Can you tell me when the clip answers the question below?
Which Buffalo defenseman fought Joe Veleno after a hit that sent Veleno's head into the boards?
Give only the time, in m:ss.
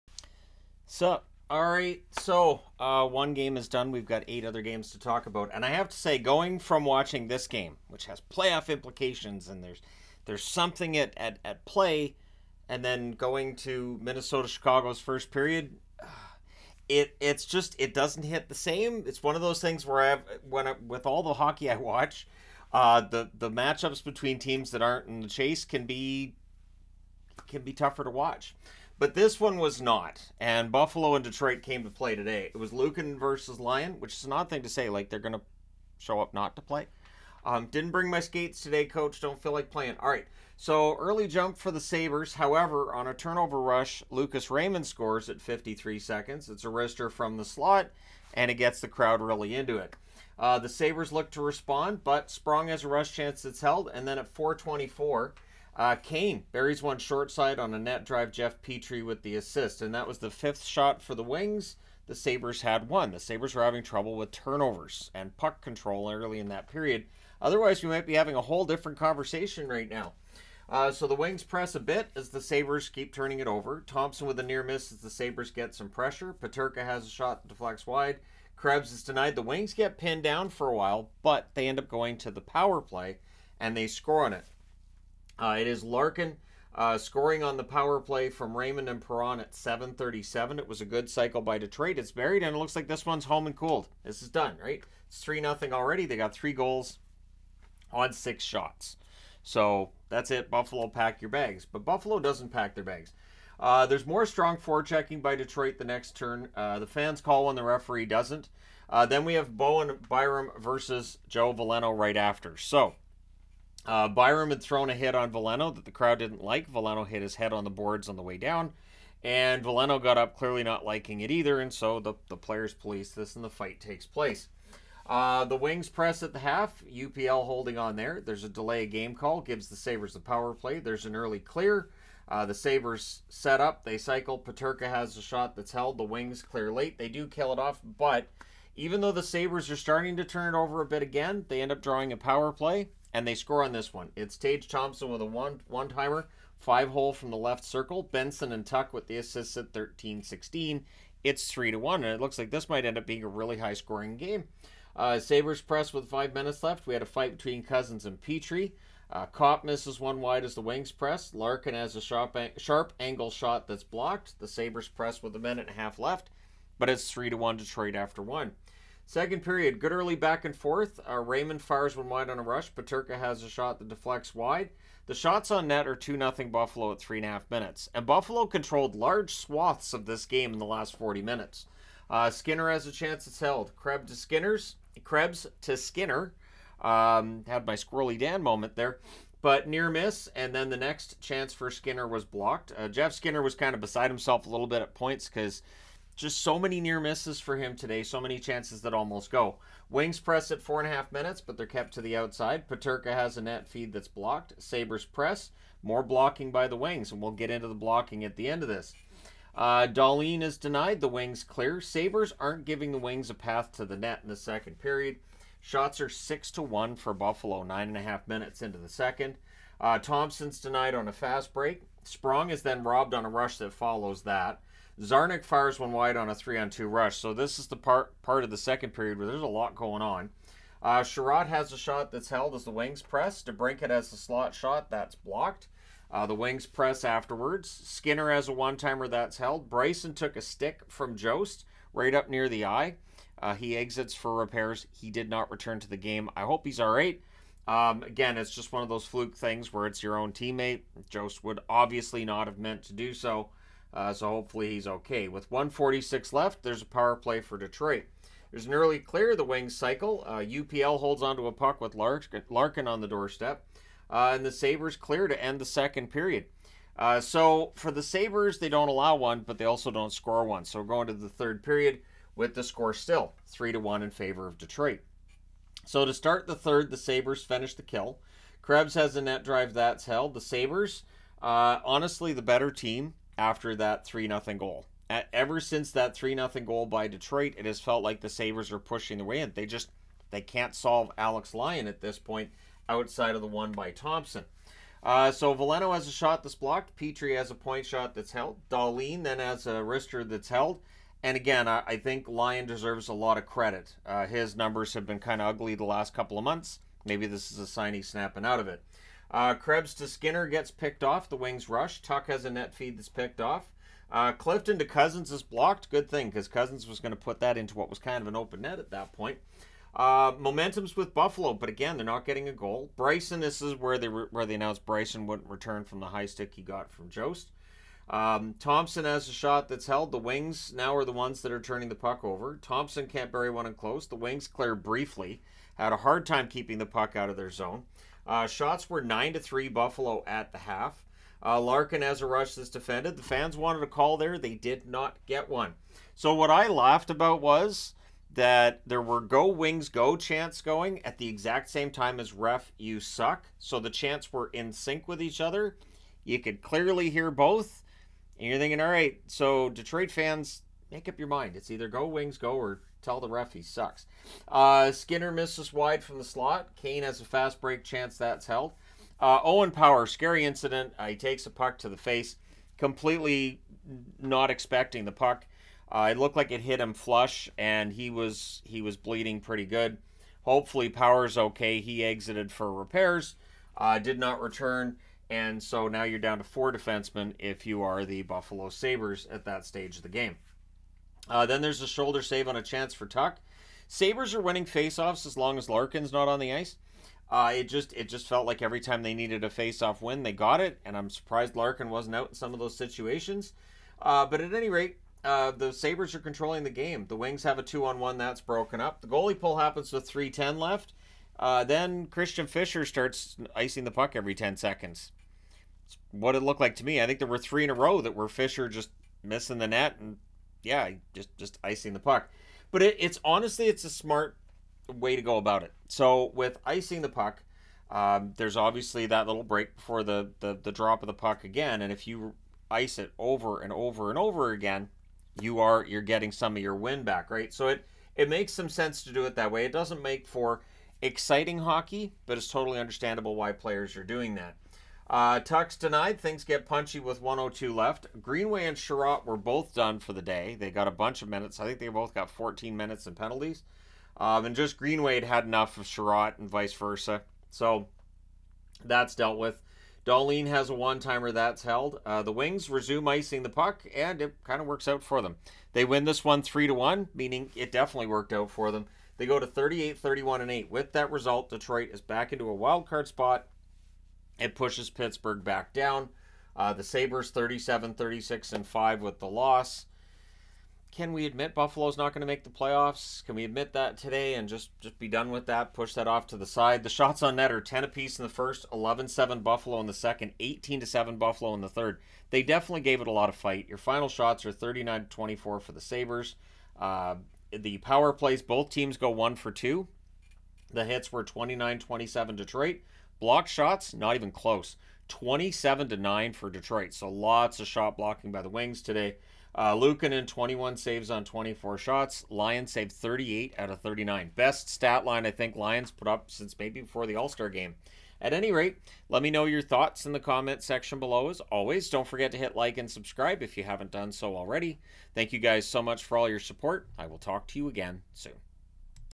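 1:49.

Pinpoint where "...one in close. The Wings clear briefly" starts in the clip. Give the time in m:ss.
5:33.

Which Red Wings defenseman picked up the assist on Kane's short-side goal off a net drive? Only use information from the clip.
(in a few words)
Jeff Petry.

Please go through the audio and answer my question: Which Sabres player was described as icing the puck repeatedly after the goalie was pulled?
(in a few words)
Christian Fischer.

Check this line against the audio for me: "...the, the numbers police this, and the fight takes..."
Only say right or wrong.
wrong.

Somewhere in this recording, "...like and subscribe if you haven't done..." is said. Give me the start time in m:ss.
8:42.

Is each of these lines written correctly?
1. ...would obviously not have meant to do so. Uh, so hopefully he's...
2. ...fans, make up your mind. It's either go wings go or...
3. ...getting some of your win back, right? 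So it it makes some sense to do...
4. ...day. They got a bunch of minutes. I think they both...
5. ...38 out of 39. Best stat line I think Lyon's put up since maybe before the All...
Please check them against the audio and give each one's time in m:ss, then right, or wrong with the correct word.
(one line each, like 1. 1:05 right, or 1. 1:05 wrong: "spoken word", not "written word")
1. 4:11 right
2. 6:00 right
3. 7:16 right
4. 7:30 right
5. 8:32 right.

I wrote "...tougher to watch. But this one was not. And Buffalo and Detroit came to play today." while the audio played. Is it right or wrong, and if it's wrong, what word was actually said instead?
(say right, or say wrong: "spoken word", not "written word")
right.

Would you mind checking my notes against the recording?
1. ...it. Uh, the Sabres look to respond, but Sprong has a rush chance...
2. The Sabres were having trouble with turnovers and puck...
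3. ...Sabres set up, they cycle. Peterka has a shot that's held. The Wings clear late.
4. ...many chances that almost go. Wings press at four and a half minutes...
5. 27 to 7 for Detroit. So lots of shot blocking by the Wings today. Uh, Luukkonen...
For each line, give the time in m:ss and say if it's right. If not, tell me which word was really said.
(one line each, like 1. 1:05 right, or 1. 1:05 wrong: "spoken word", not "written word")
1. 0:49 right
2. 1:03 right
3. 2:12 right
4. 3:18 right
5. 8:25 wrong: "9", not "7".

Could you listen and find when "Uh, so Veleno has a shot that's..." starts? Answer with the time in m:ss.
4:55.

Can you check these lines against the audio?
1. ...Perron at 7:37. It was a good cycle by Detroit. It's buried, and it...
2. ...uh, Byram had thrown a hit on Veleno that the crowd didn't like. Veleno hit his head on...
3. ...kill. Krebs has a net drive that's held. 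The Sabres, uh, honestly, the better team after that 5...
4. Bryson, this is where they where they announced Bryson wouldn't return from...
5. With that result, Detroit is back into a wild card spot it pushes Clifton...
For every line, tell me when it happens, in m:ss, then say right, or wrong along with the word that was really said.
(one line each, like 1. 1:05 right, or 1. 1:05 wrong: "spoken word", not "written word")
1. 1:29 right
2. 1:53 right
3. 4:37 wrong: "3", not "5"
4. 5:22 right
5. 7:50 wrong: "Pittsburgh", not "Clifton".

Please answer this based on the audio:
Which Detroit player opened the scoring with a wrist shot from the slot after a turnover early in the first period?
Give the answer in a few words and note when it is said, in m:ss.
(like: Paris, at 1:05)
Lucas Raymond, at 0:44.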